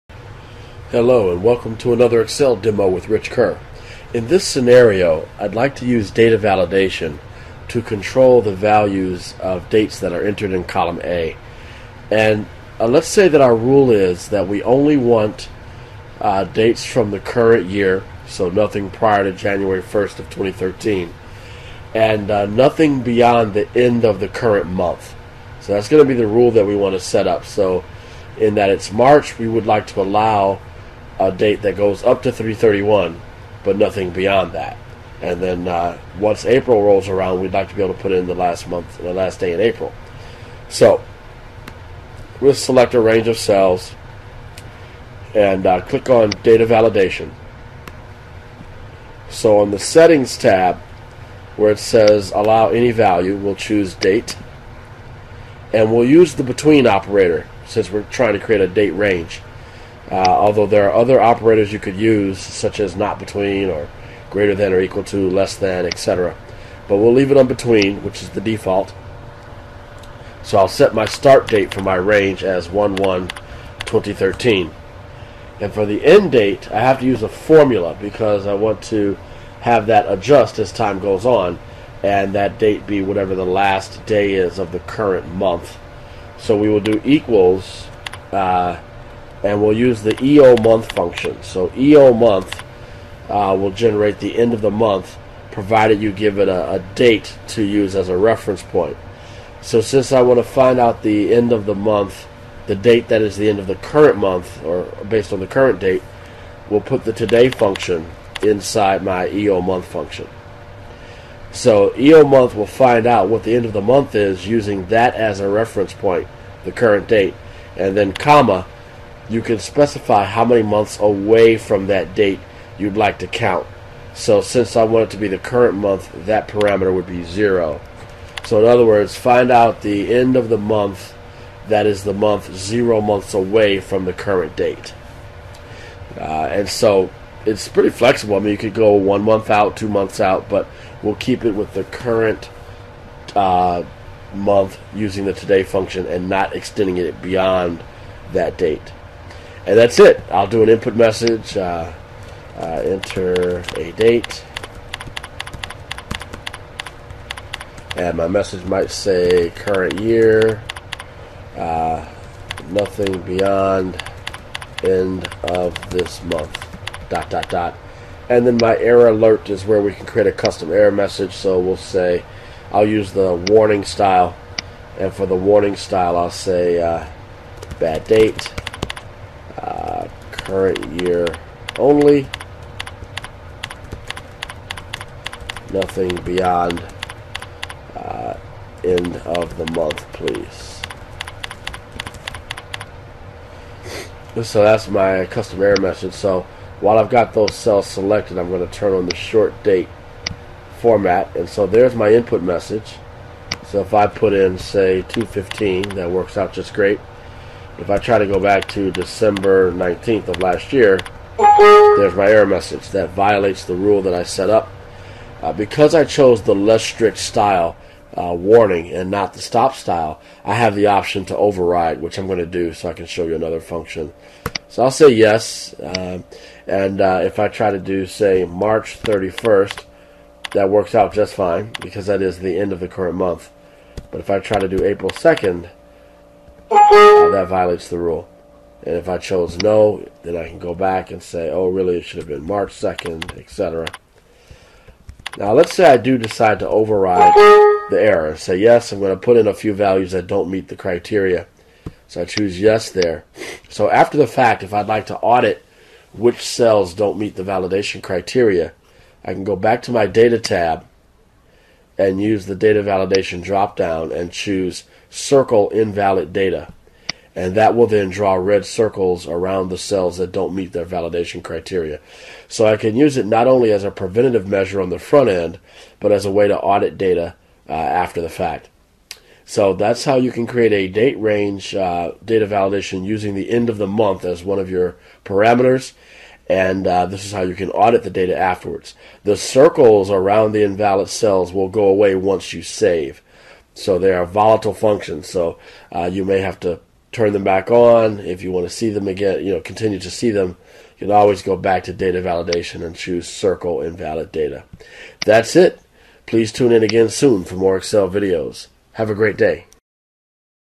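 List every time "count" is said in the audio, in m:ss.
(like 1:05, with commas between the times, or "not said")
2:03.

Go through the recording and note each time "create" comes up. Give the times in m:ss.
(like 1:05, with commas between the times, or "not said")
0:58, 2:50, 4:40.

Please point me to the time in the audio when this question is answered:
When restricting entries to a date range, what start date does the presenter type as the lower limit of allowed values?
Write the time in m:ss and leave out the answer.
1:12.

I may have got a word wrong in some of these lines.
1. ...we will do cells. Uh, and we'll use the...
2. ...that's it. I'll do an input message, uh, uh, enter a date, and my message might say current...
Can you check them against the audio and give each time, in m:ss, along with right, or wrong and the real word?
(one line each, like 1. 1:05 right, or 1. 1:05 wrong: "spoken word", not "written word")
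1. 1:26 wrong: "equals", not "cells"
2. 2:29 right.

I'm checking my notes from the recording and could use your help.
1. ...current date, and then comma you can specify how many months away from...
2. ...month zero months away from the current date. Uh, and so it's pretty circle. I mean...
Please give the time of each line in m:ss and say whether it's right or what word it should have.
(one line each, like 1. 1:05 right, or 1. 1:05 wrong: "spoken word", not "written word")
1. 1:56 right
2. 2:12 wrong: "flexible", not "circle".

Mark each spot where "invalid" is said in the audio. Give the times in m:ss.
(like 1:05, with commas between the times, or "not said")
4:25, 4:50, 5:03.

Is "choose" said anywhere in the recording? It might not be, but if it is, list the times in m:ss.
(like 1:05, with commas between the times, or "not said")
0:53, 4:12, 4:24, 5:02.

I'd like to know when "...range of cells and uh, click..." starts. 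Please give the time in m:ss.
0:42.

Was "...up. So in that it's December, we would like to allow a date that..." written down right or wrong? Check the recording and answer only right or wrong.
wrong.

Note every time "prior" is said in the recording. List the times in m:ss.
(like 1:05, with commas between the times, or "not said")
0:18.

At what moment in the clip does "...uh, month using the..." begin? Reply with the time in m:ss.
2:23.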